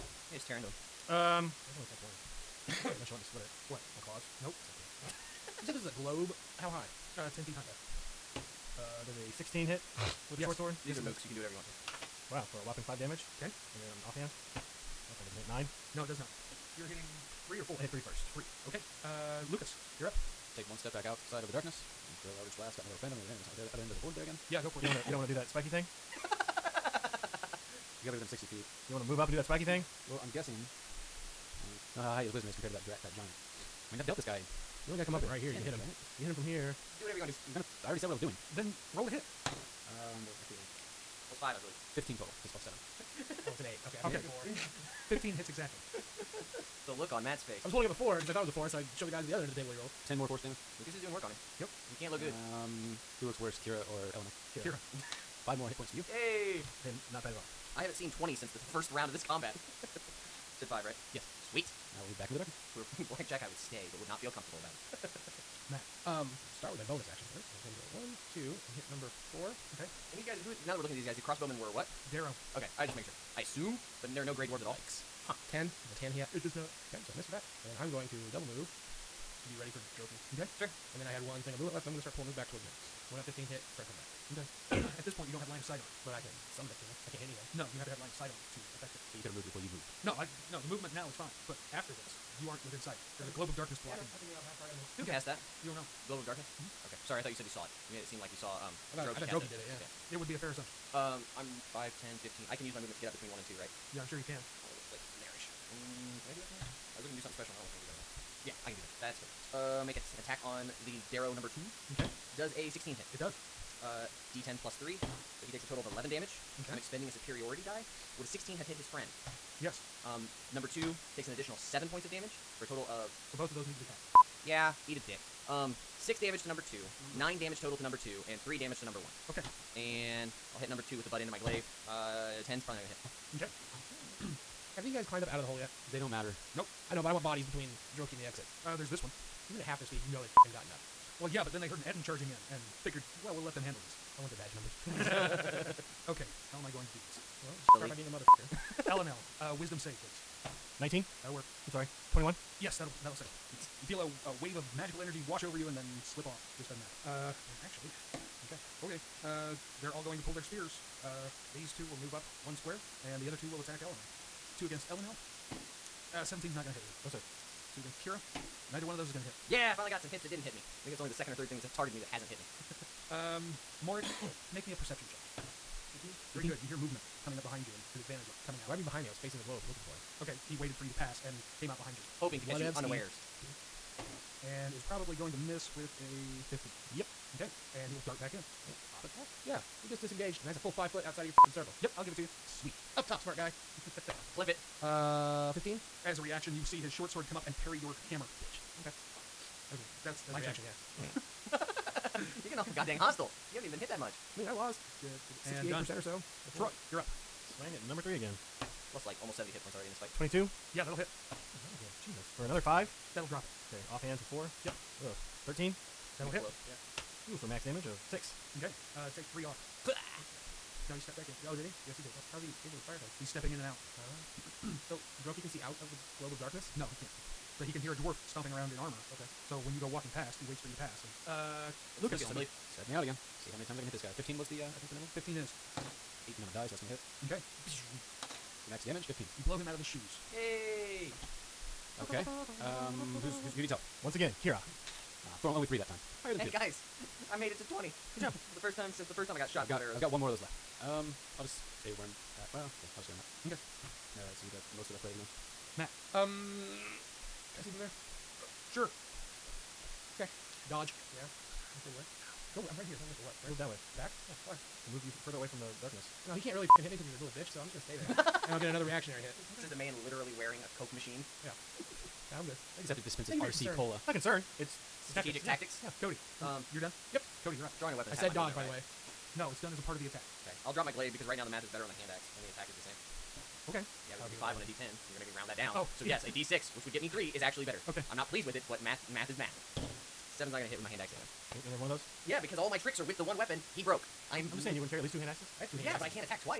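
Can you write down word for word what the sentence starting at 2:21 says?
Well, yeah, but then they heard an Ettin charging in and figured, well, we'll let them handle this.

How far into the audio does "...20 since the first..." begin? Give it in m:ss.
0:58.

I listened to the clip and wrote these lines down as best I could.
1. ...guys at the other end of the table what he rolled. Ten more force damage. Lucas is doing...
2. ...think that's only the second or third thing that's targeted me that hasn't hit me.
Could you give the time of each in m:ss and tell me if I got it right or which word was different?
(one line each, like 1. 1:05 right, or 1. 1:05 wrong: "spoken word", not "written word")
1. 0:49 right
2. 2:50 right.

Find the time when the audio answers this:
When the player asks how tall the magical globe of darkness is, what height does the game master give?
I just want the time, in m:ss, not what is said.
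0:07.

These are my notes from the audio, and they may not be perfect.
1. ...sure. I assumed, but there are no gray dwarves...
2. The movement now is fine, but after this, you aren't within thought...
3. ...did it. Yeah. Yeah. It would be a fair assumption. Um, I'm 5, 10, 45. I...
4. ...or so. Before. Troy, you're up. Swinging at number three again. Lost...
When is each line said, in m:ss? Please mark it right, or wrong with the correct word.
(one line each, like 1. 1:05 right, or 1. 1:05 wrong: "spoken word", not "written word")
1. 1:13 right
2. 1:30 wrong: "sight", not "thought"
3. 1:39 wrong: "15", not "45"
4. 3:25 right.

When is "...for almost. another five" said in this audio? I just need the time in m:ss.
3:32.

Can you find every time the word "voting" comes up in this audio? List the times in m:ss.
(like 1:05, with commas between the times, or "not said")
not said.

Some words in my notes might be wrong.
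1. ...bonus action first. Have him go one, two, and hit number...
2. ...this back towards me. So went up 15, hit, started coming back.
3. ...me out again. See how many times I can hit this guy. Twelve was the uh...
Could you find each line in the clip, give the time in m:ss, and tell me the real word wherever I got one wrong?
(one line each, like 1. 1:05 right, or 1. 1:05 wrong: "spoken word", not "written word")
1. 1:06 right
2. 1:22 right
3. 3:52 wrong: "Fifteen", not "Twelve".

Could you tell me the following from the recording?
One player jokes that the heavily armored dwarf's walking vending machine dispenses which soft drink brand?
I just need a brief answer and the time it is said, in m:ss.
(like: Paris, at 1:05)
RC Cola, at 4:33.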